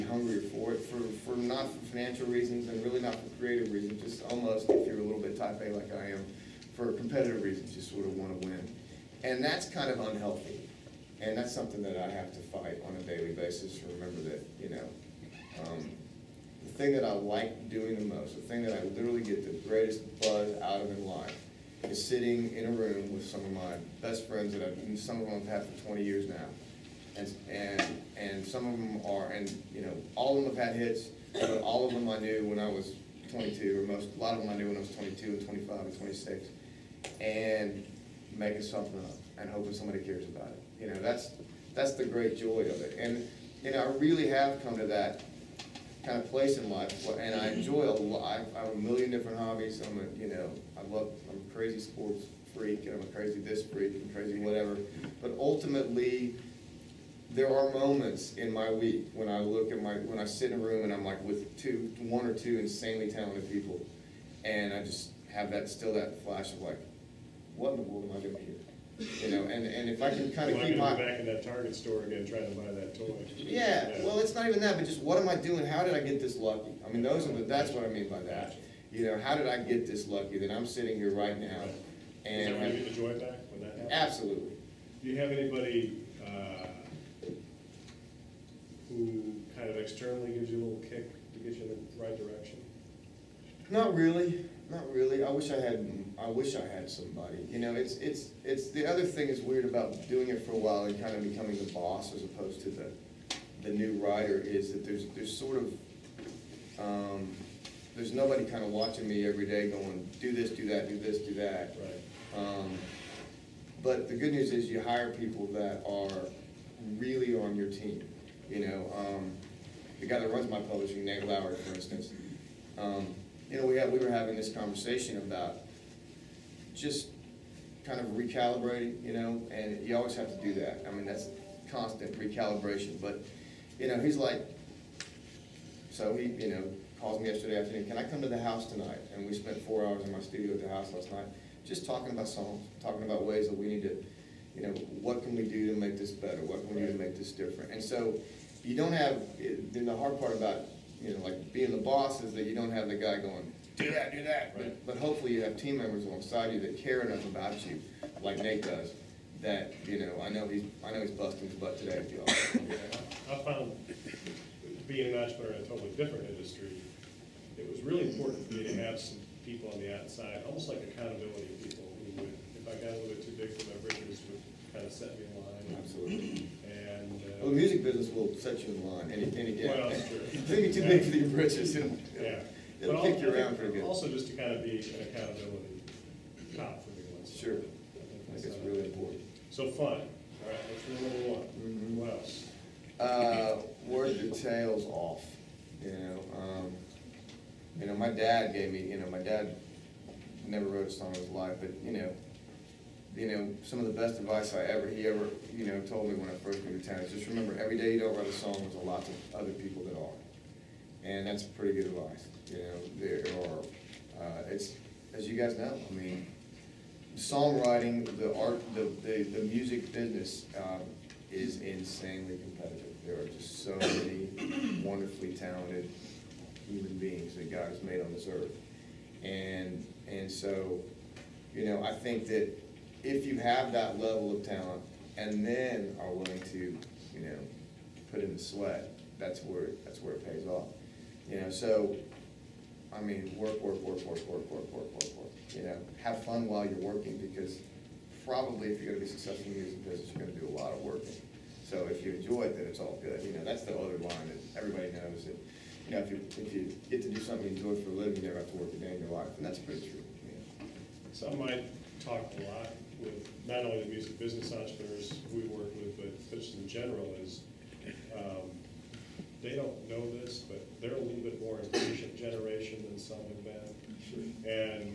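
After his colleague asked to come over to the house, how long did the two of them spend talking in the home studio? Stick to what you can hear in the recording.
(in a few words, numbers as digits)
4 hours.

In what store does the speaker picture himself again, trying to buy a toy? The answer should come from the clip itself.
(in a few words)
Target.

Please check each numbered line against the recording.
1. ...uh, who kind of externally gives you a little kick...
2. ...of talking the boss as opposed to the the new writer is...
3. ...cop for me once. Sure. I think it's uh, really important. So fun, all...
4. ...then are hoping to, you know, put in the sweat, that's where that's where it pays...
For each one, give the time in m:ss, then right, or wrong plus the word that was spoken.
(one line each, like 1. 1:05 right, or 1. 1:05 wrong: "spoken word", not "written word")
1. 1:26 right
2. 1:41 wrong: "becoming", not "talking"
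3. 3:06 right
4. 3:55 wrong: "willing", not "hoping".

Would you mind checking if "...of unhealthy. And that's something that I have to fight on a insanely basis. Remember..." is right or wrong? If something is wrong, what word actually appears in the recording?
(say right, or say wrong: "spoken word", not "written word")
wrong: "daily", not "insanely".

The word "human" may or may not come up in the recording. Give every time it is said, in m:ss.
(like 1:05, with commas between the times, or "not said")
3:46.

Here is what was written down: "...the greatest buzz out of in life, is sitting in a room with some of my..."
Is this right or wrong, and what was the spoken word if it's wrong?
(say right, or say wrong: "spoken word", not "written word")
right.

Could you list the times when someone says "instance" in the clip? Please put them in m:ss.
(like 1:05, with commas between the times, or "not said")
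2:01.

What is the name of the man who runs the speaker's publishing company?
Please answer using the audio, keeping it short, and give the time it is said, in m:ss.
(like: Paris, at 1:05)
Nate Lauer, at 2:01.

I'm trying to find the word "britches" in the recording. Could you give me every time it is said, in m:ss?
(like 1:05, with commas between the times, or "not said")
2:53, 3:01.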